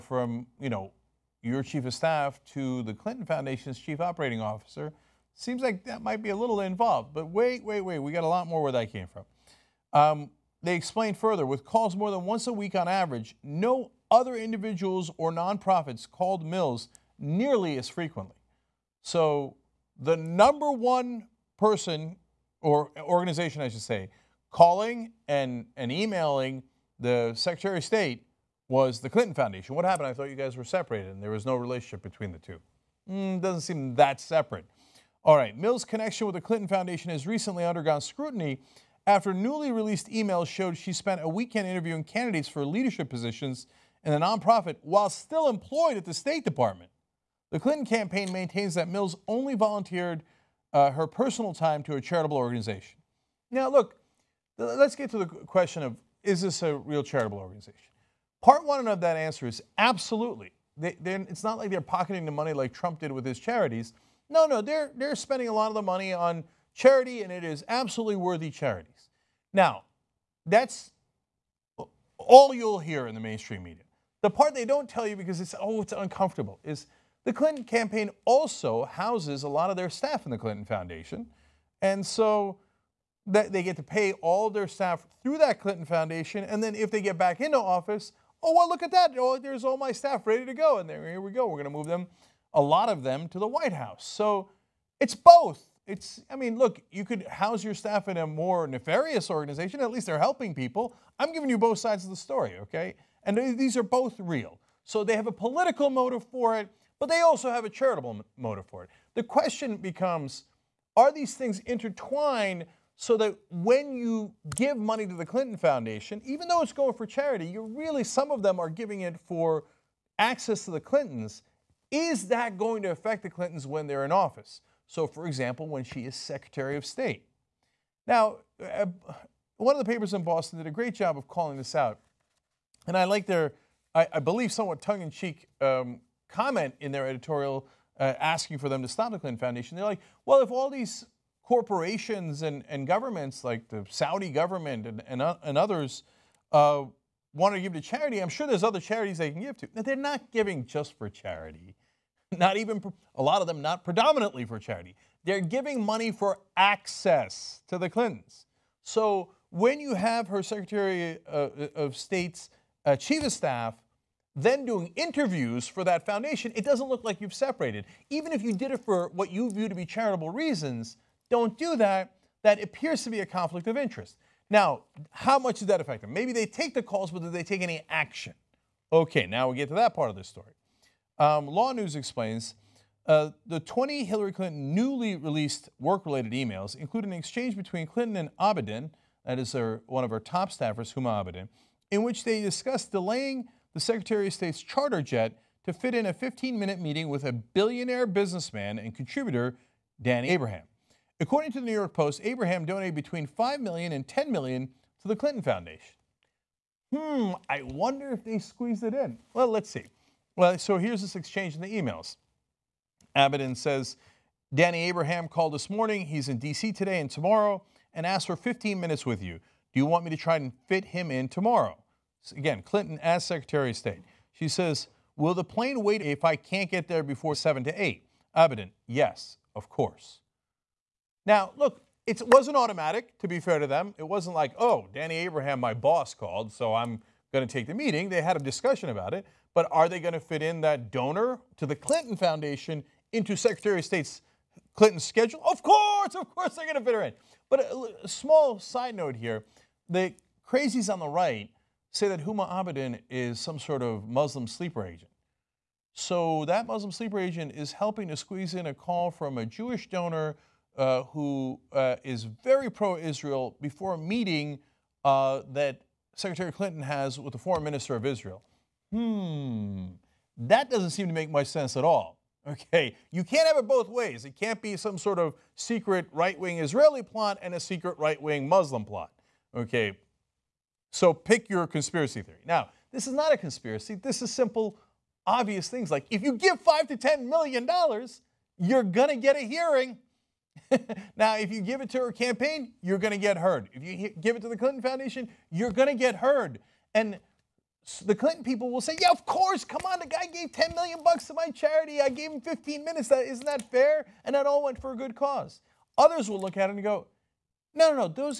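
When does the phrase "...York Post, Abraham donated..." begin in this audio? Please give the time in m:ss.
3:21.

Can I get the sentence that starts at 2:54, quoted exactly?
Now, how much does that affect them?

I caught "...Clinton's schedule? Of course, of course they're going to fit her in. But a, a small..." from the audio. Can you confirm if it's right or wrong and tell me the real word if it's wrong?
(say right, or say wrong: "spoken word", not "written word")
right.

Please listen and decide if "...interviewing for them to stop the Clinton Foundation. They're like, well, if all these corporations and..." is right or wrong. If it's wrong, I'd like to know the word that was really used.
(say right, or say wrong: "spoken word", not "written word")
wrong: "asking", not "interviewing".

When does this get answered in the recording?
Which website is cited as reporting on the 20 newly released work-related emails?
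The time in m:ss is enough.
3:01.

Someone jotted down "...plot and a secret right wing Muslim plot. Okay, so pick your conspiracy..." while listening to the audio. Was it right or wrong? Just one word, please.
right.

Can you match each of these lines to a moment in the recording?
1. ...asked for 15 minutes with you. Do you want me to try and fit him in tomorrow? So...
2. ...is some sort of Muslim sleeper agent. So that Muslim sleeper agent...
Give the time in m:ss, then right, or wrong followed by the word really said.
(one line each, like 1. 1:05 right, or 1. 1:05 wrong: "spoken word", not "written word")
1. 3:38 right
2. 4:13 right.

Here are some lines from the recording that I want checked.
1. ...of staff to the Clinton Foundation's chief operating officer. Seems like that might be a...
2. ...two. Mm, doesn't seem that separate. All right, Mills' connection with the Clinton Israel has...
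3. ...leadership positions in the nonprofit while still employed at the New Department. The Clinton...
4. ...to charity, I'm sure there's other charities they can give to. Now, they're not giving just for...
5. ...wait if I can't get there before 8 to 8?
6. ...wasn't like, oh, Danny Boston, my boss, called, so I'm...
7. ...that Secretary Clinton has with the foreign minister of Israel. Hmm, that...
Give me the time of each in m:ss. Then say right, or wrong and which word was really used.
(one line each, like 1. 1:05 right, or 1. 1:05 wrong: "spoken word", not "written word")
1. 0:01 right
2. 0:32 wrong: "Foundation", not "Israel"
3. 0:42 wrong: "State", not "New"
4. 2:27 right
5. 3:45 wrong: "7", not "8"
6. 3:54 wrong: "Abraham", not "Boston"
7. 4:25 right.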